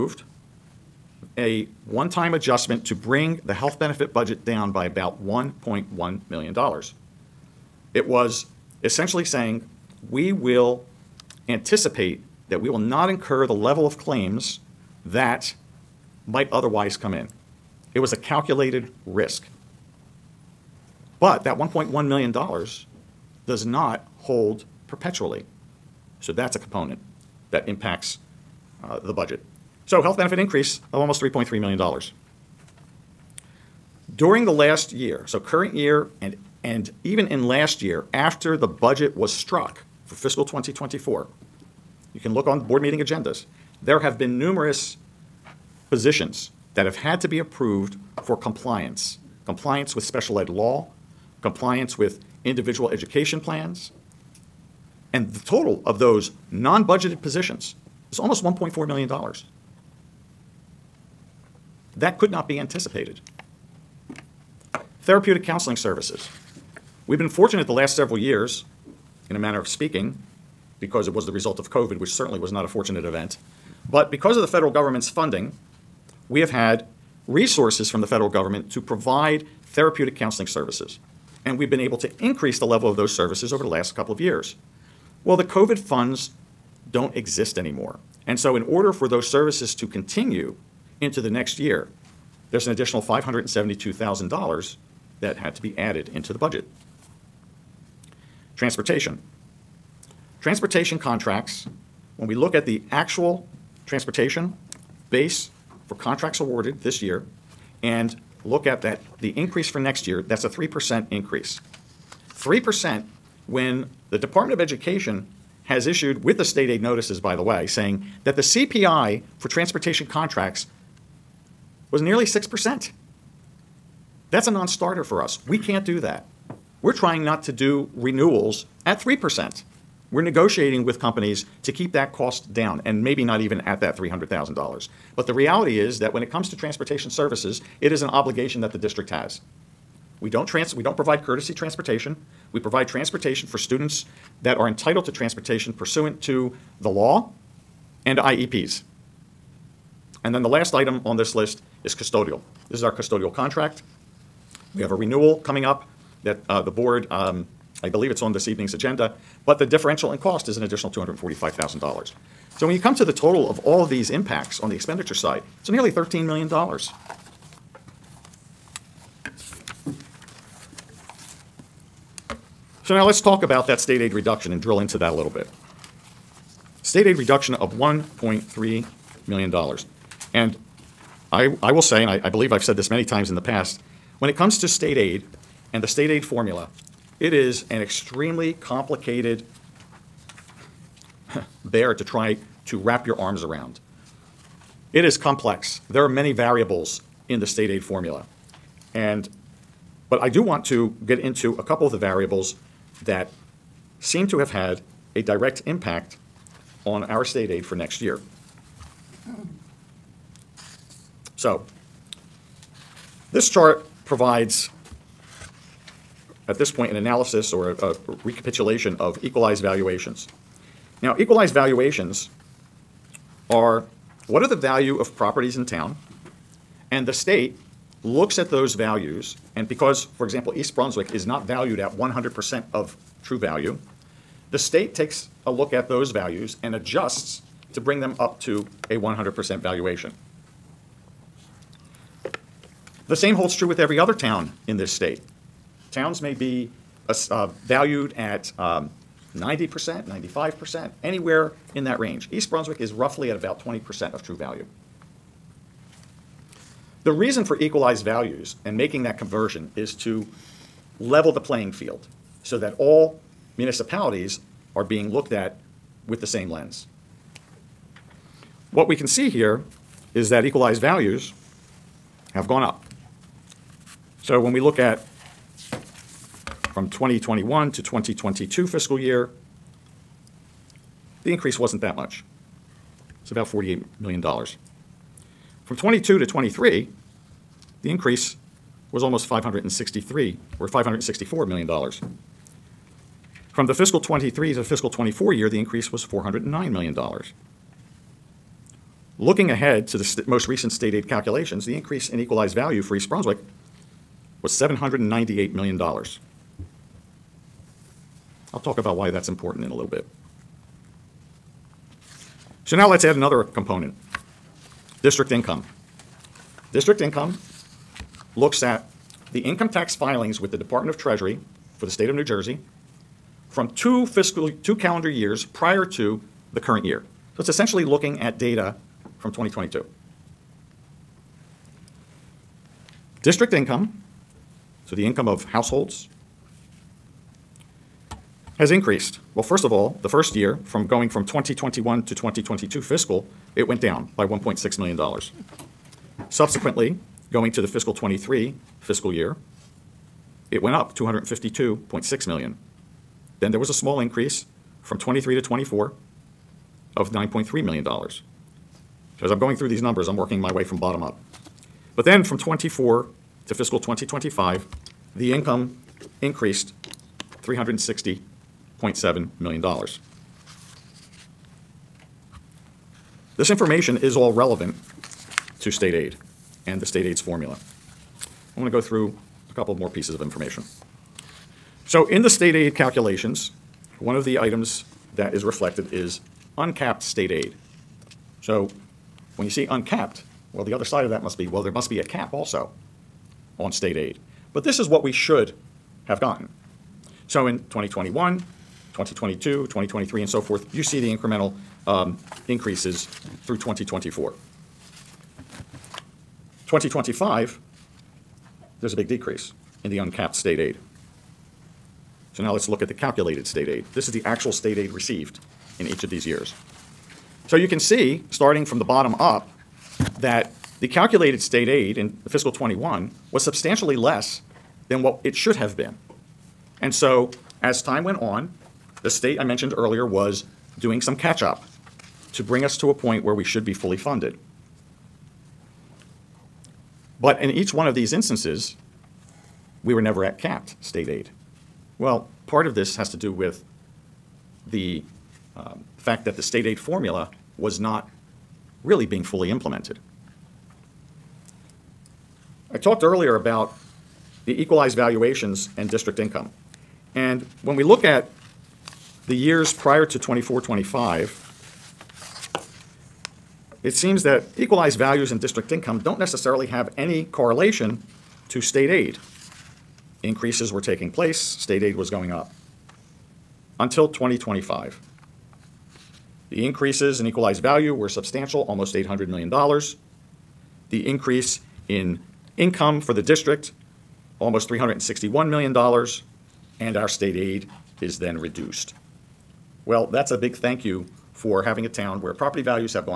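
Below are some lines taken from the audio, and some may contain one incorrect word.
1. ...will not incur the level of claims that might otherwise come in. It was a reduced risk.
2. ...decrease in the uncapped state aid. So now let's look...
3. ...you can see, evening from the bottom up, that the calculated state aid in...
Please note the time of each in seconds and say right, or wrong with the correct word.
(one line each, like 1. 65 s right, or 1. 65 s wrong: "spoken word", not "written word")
1. 12 s wrong: "calculated", not "reduced"
2. 409 s right
3. 417 s wrong: "starting", not "evening".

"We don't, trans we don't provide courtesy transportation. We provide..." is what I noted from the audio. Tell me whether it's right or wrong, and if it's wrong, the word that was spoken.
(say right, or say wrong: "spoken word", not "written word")
right.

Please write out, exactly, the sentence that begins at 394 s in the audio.
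But this is what we should have gotten.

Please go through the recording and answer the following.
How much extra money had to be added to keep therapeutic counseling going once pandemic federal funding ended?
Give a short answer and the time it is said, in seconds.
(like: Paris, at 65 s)
$572,000, at 92 s.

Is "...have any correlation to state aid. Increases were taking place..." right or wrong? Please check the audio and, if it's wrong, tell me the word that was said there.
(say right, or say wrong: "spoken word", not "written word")
right.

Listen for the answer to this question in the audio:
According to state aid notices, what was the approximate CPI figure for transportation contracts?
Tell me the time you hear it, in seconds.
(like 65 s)
122 s.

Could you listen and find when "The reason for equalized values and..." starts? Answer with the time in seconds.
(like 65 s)
257 s.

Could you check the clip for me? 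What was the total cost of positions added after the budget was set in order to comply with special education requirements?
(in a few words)
$1.4 million.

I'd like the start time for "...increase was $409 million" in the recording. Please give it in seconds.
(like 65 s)
295 s.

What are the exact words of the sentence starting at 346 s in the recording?
Subsequently, going to the fiscal 23 fiscal year, it went up 252.6 million.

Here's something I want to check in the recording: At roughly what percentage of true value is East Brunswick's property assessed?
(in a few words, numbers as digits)
20%.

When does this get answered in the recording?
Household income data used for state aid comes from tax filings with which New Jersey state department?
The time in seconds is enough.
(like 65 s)
320 s.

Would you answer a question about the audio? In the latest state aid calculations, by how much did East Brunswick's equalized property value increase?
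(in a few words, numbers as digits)
$798 million.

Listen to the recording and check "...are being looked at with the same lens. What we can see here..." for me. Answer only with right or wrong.
right.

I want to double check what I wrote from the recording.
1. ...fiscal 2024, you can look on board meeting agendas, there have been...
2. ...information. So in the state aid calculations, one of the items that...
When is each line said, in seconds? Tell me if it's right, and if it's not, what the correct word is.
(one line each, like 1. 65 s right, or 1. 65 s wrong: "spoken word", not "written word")
1. 40 s right
2. 380 s right.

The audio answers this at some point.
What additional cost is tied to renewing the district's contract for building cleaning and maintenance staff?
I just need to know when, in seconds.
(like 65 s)
160 s.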